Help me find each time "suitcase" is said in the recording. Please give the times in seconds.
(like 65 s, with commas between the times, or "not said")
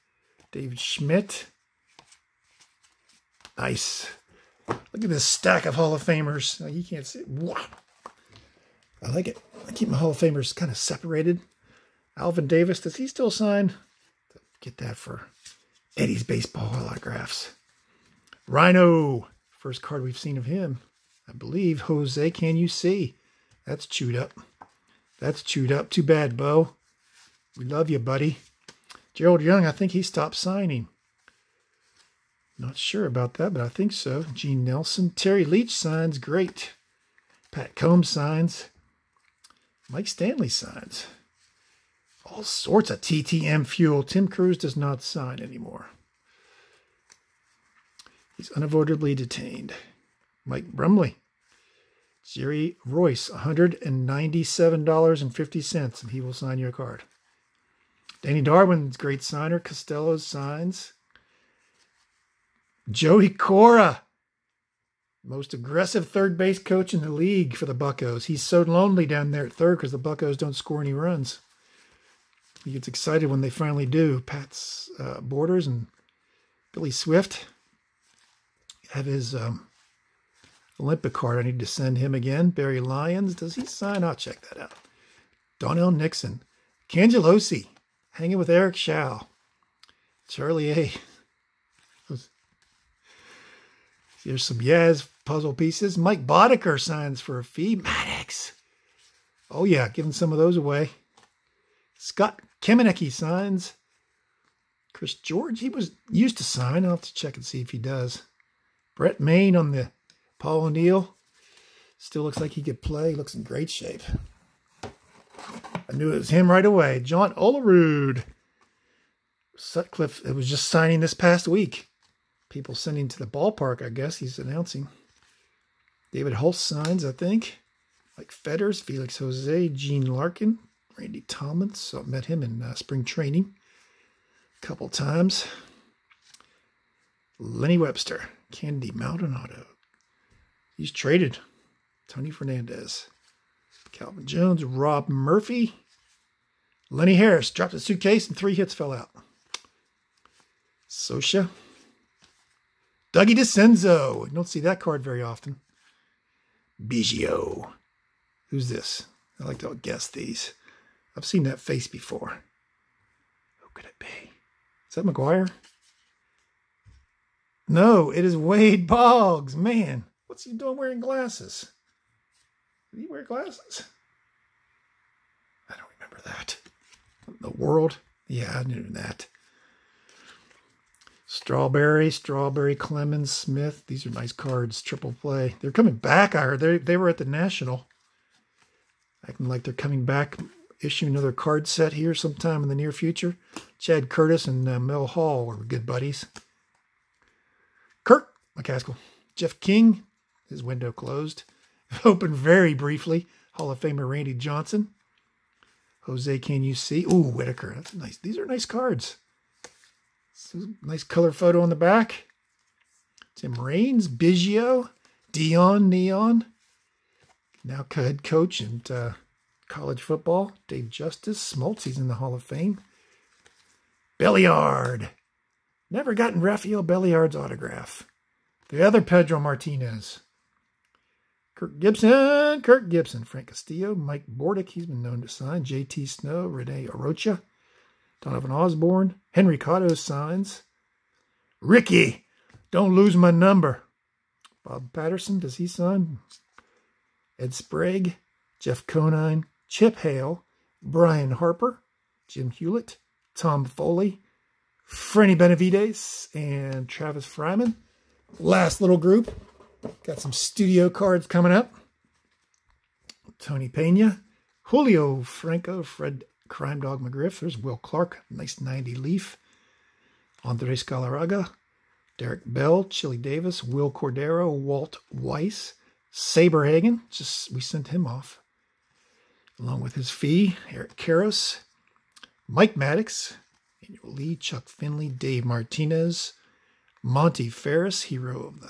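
147 s.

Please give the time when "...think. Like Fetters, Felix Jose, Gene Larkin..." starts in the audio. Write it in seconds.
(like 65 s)
127 s.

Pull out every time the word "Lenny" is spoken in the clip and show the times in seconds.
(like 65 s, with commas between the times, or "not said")
137 s, 146 s.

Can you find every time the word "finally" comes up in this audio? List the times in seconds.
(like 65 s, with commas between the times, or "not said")
73 s.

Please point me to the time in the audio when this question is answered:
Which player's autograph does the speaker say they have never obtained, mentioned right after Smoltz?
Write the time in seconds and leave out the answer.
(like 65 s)
226 s.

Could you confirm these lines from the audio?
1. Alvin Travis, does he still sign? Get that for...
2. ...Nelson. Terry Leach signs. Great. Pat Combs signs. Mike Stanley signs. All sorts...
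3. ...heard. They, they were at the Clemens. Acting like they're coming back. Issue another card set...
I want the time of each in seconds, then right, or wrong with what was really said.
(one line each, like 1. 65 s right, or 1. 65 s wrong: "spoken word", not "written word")
1. 12 s wrong: "Davis", not "Travis"
2. 34 s right
3. 186 s wrong: "National", not "Clemens".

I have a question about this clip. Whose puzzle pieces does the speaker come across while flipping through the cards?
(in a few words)
Yaz.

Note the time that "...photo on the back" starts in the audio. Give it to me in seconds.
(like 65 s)
211 s.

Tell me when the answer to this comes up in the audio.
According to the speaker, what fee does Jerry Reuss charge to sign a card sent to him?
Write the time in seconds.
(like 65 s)
53 s.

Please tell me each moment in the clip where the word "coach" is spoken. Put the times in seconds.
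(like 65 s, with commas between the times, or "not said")
66 s, 218 s.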